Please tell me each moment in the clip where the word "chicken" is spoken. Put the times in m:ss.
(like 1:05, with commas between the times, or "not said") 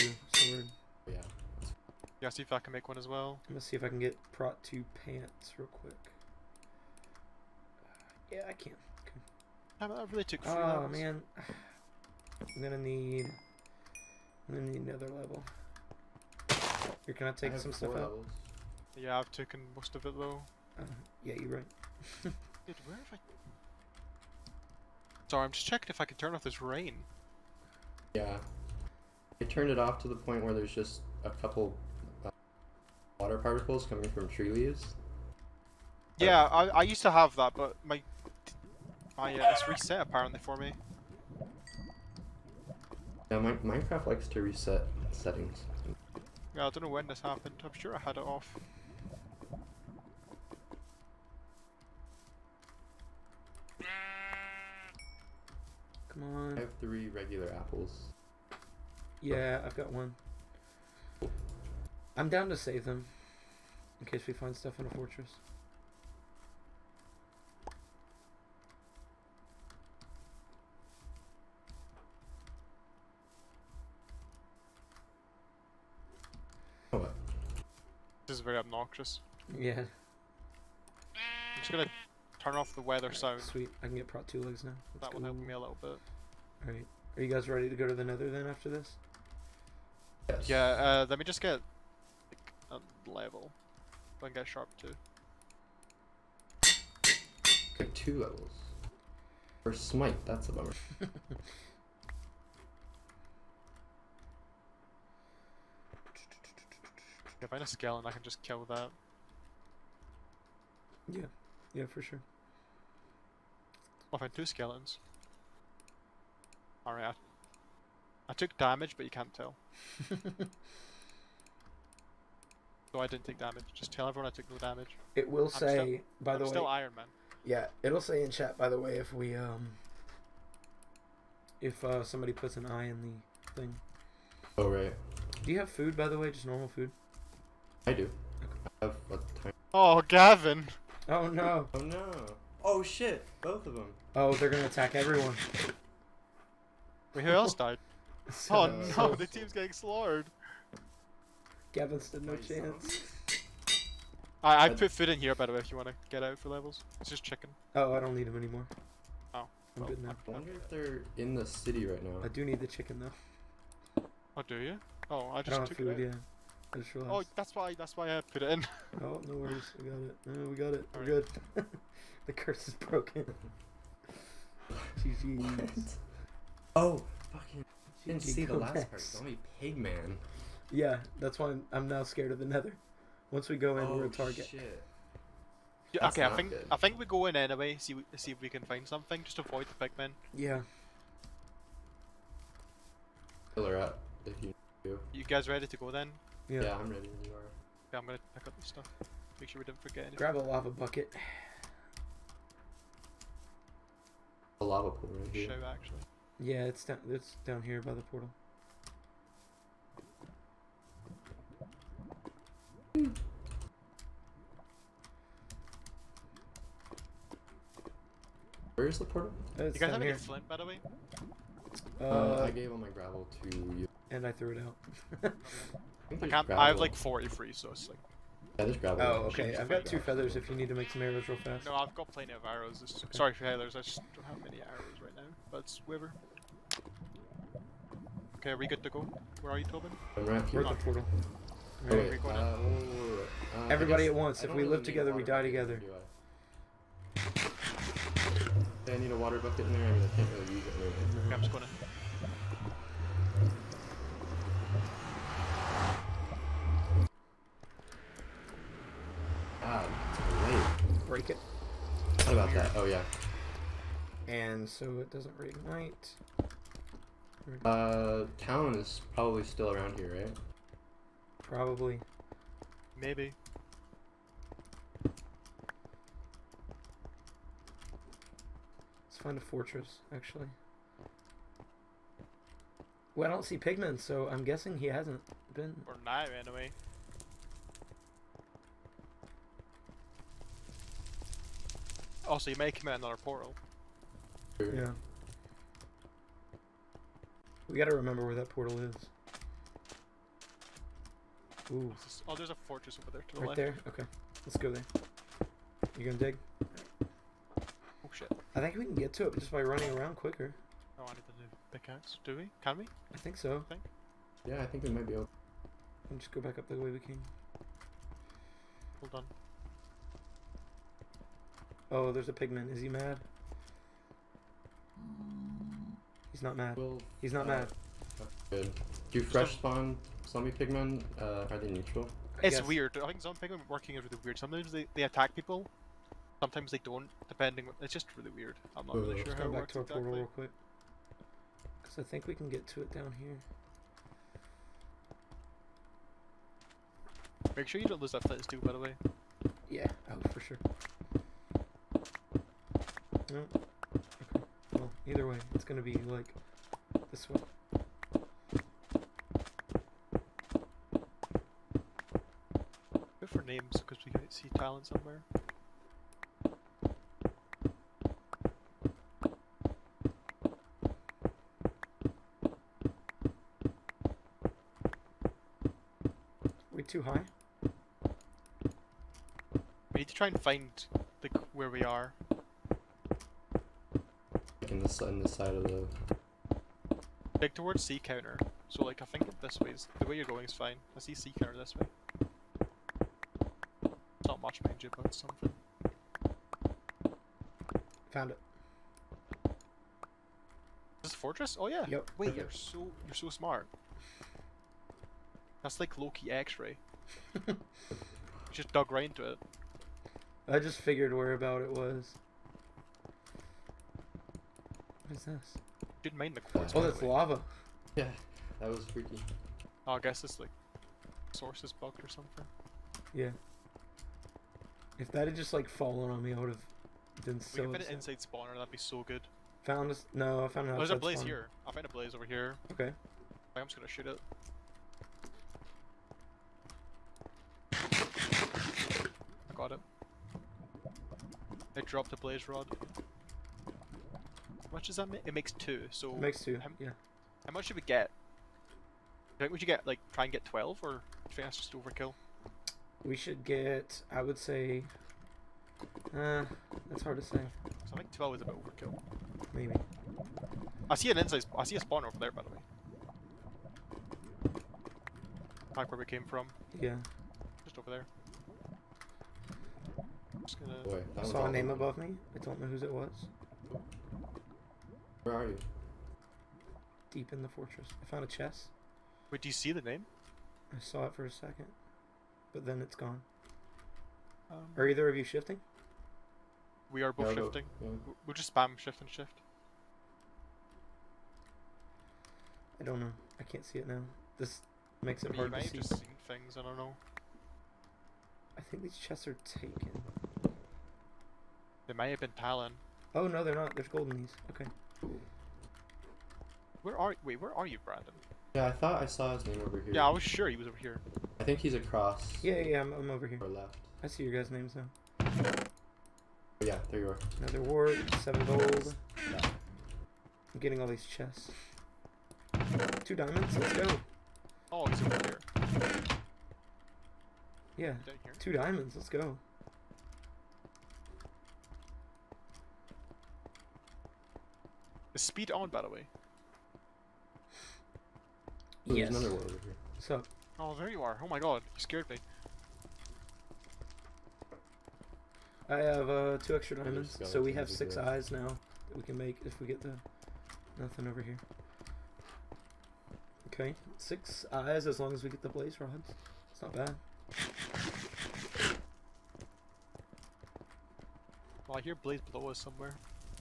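2:37, 2:42.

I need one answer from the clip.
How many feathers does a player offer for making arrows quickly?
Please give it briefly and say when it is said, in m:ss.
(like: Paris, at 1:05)
2, at 3:49.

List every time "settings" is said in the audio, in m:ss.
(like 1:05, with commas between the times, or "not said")
0:45.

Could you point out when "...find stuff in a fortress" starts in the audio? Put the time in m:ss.
1:04.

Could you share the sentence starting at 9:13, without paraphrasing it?
Okay, six eyes as long as we get the blaze rods.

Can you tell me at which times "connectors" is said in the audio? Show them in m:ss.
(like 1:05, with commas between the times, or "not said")
not said.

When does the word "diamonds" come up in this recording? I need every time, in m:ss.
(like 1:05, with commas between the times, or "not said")
8:43, 8:48, 9:06.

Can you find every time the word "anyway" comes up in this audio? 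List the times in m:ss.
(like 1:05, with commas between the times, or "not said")
3:07, 4:46.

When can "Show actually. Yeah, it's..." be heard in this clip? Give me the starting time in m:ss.
3:25.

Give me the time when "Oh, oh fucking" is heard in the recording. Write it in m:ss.
2:56.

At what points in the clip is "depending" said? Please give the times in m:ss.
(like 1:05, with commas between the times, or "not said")
5:37.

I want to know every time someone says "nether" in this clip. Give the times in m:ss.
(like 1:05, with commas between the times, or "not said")
1:28, 3:02.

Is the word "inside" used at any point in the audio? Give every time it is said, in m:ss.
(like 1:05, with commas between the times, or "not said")
7:07, 7:41.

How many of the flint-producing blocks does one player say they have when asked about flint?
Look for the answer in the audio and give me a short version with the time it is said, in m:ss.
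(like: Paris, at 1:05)
43, at 3:46.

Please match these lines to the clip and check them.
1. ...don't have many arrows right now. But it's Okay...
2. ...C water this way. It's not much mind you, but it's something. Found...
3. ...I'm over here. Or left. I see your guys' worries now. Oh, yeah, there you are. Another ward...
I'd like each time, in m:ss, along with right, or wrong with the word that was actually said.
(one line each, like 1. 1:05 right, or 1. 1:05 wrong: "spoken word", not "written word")
1. 3:54 right
2. 6:31 wrong: "counter", not "water"
3. 8:32 wrong: "names", not "worries".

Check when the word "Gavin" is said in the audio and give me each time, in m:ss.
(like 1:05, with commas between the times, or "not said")
2:20, 2:31.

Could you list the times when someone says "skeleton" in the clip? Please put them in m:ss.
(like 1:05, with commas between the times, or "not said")
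1:47, 1:54.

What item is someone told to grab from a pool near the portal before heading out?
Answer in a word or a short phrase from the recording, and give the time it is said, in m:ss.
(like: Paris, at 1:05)
Lava bucket, at 3:20.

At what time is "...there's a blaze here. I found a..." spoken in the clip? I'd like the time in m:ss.
7:10.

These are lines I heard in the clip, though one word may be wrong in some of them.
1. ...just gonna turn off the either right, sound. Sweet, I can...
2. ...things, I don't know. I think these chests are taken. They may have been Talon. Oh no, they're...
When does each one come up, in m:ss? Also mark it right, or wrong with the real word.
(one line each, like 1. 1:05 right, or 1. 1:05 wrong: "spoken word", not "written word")
1. 1:21 wrong: "weather", not "either"
2. 8:16 right.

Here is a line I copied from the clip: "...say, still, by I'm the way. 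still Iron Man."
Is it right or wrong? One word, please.
right.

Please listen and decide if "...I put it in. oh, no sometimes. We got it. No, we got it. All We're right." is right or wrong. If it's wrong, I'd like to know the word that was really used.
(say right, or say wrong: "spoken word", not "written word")
wrong: "worries", not "sometimes".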